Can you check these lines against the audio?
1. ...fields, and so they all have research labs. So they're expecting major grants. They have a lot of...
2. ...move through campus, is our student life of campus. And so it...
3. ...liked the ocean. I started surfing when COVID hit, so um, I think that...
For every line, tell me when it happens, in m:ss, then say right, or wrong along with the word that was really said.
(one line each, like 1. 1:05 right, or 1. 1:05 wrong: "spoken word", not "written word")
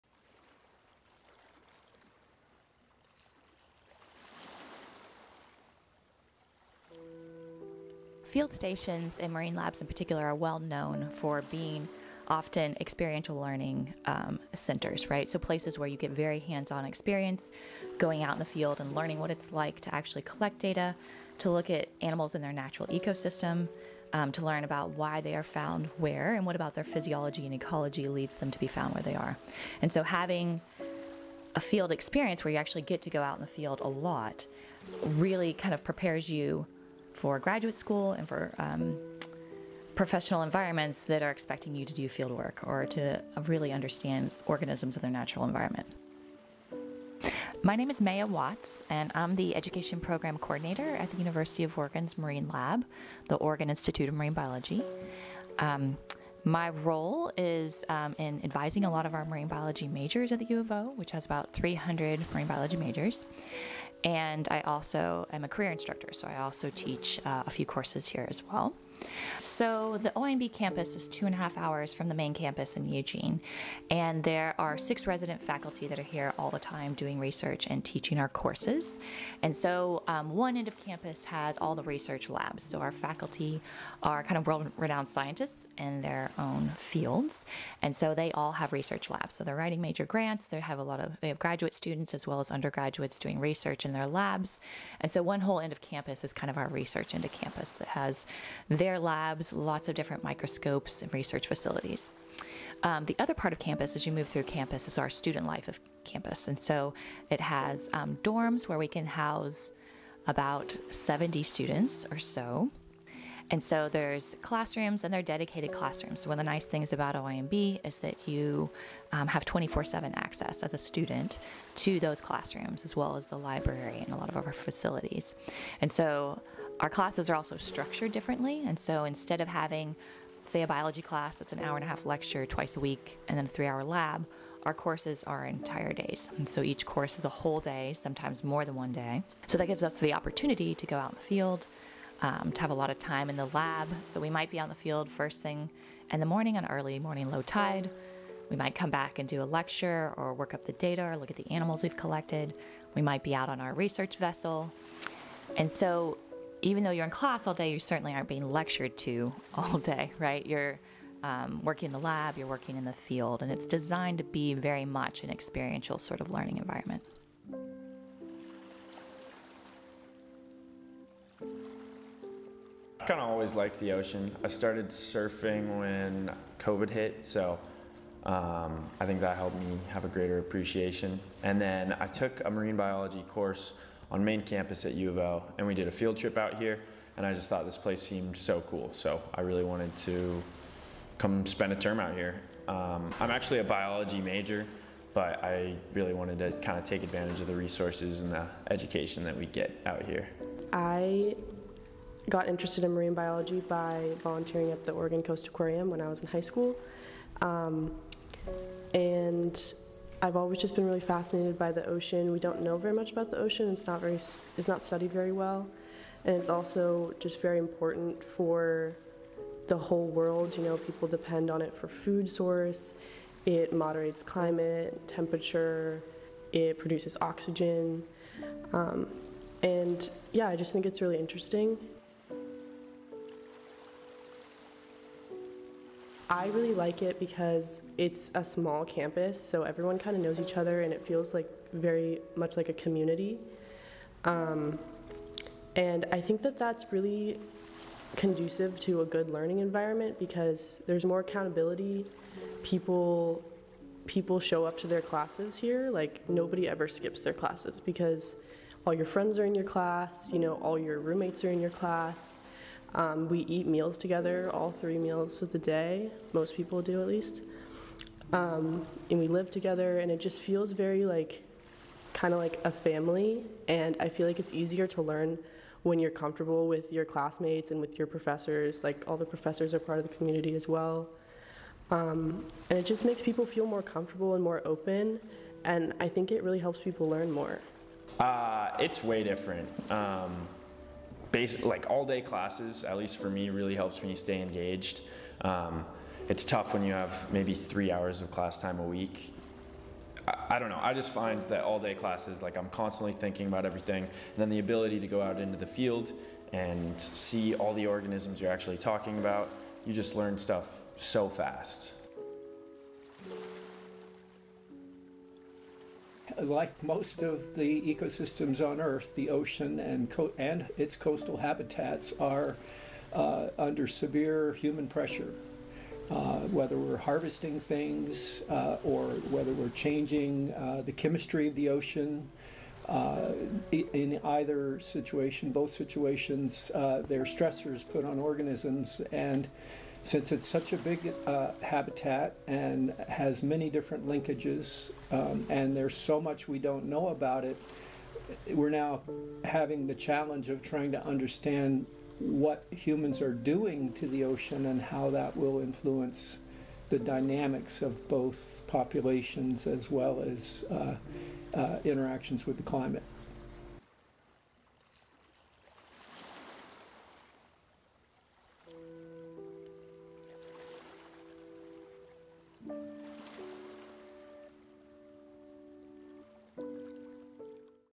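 1. 1:26 wrong: "writing", not "expecting"
2. 1:44 right
3. 2:53 right.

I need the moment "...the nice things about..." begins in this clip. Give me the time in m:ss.
1:56.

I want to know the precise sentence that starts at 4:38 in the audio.
Like all the professors are part of the community as well.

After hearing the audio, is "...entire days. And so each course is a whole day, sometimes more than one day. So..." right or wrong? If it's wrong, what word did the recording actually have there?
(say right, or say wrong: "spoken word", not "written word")
right.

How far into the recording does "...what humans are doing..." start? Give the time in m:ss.
5:52.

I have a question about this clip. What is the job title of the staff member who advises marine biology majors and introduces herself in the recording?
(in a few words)
Education Program Coordinator.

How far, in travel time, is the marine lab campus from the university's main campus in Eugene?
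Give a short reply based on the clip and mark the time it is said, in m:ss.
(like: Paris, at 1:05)
2.5 hours, at 1:11.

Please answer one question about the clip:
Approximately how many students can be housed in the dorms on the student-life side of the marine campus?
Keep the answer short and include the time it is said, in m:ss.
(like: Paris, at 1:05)
70, at 1:50.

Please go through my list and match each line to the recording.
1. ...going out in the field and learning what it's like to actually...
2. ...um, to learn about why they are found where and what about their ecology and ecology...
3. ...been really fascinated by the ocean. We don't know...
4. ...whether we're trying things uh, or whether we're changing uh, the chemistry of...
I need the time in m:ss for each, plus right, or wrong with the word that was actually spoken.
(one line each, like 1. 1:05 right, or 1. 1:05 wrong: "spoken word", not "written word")
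1. 0:17 right
2. 0:24 wrong: "physiology", not "ecology"
3. 3:30 right
4. 5:26 wrong: "harvesting", not "trying".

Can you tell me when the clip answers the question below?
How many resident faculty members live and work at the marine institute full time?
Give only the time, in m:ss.
1:14.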